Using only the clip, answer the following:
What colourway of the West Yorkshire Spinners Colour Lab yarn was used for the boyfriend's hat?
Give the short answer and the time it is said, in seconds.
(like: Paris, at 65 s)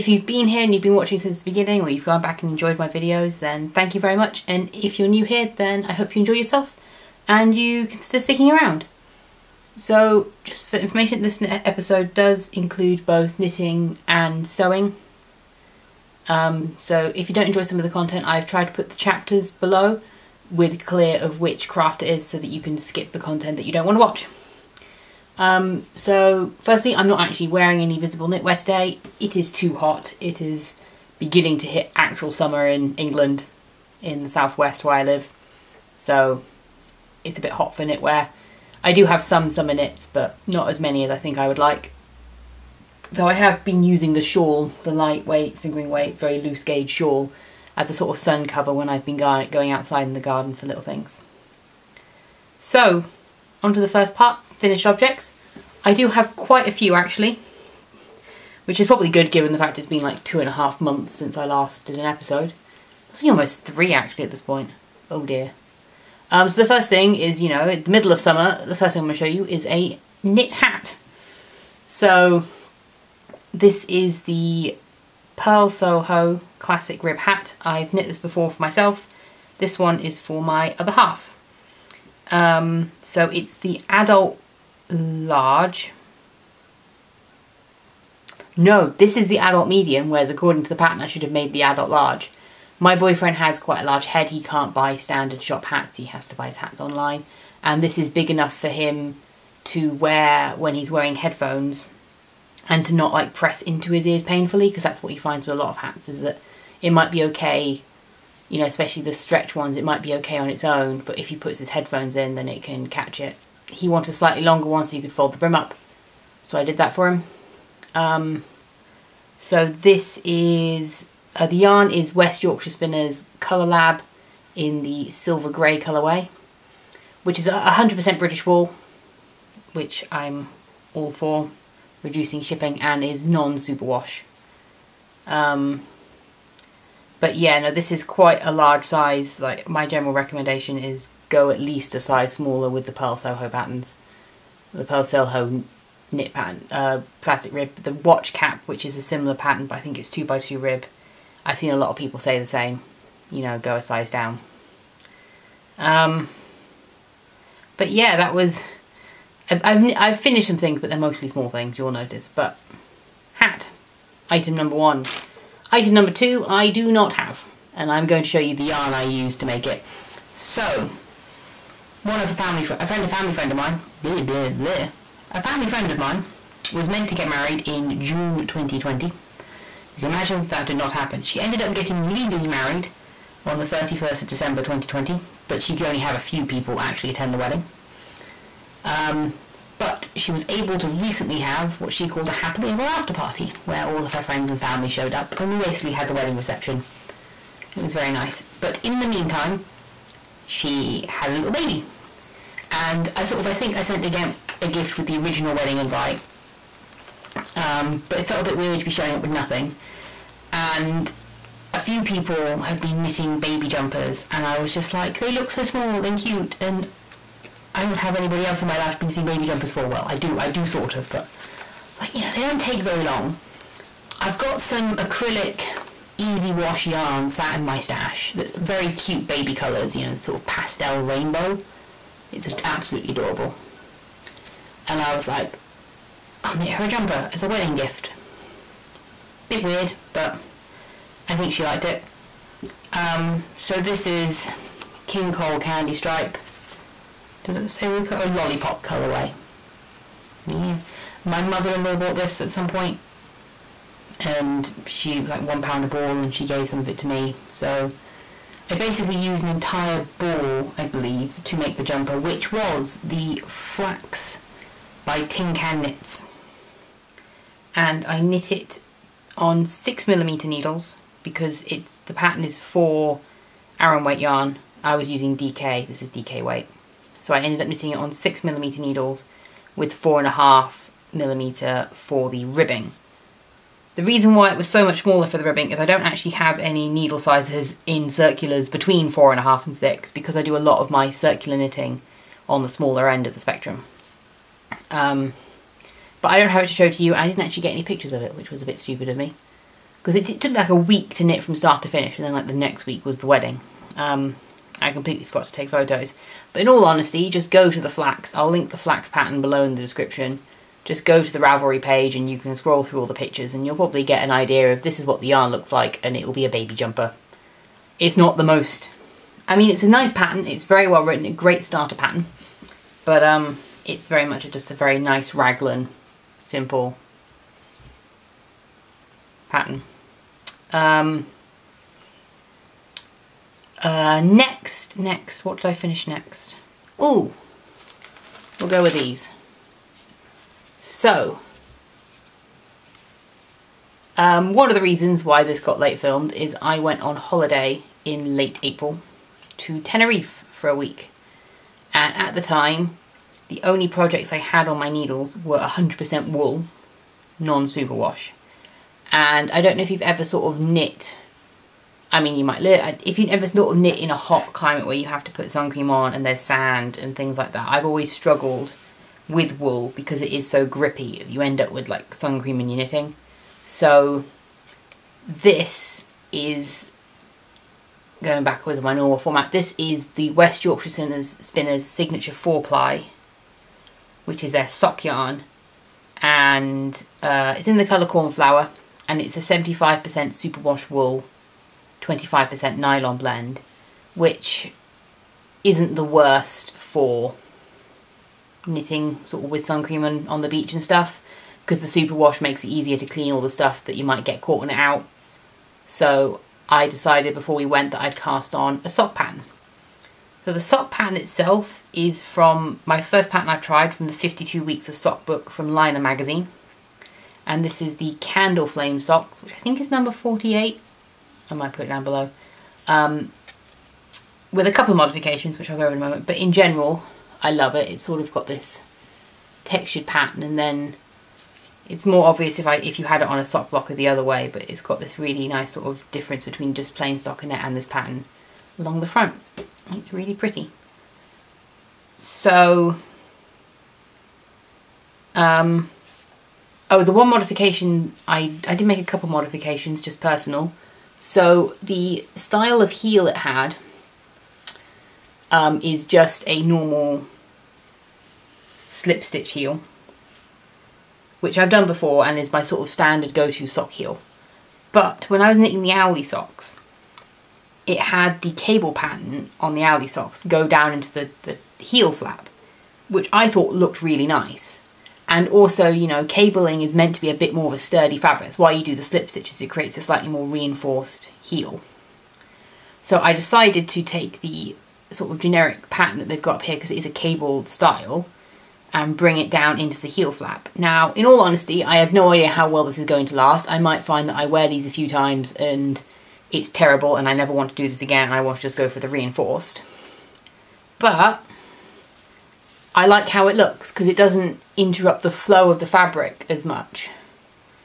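silver grey, at 125 s.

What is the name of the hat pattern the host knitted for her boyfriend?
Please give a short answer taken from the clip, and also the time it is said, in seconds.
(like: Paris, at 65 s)
Purl Soho Classic Rib Hat, at 75 s.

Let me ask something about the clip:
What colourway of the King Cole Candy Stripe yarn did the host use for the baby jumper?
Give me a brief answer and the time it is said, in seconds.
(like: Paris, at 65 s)
Lollipop, at 248 s.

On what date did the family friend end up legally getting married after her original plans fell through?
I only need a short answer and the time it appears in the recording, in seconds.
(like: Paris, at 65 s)
31 December 2020, at 183 s.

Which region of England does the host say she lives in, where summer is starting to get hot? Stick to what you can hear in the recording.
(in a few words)
the southwest.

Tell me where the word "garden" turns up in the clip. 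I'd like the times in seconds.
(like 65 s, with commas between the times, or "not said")
50 s.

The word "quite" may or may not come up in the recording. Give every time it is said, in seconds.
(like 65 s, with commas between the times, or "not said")
56 s, 93 s, 138 s.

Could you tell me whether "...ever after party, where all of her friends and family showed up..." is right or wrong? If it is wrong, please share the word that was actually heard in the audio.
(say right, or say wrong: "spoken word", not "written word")
right.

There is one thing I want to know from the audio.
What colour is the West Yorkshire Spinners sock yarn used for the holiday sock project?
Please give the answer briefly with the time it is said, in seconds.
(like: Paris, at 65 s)
cornflower, at 388 s.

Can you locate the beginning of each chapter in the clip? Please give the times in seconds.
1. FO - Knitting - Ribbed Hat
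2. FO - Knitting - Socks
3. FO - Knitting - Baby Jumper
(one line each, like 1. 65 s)
1. 56 s
2. 339 s
3. 164 s.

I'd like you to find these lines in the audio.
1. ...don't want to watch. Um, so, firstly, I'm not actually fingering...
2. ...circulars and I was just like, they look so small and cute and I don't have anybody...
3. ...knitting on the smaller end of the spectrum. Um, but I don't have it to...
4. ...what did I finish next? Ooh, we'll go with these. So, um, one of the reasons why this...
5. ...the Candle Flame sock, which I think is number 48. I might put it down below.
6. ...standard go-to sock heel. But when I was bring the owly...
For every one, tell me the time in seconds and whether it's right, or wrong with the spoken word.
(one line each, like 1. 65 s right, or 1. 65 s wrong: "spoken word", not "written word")
1. 23 s wrong: "wearing", not "fingering"
2. 213 s wrong: "jumpers", not "circulars"
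3. 291 s right
4. 335 s right
5. 417 s right
6. 462 s wrong: "knitting", not "bring".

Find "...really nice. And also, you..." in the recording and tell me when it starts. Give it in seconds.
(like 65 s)
474 s.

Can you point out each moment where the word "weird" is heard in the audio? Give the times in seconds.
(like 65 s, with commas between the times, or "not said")
208 s, 239 s.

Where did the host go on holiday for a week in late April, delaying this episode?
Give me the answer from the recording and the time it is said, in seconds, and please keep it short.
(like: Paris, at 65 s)
Tenerife, at 349 s.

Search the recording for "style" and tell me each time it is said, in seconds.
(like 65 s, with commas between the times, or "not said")
452 s, 487 s.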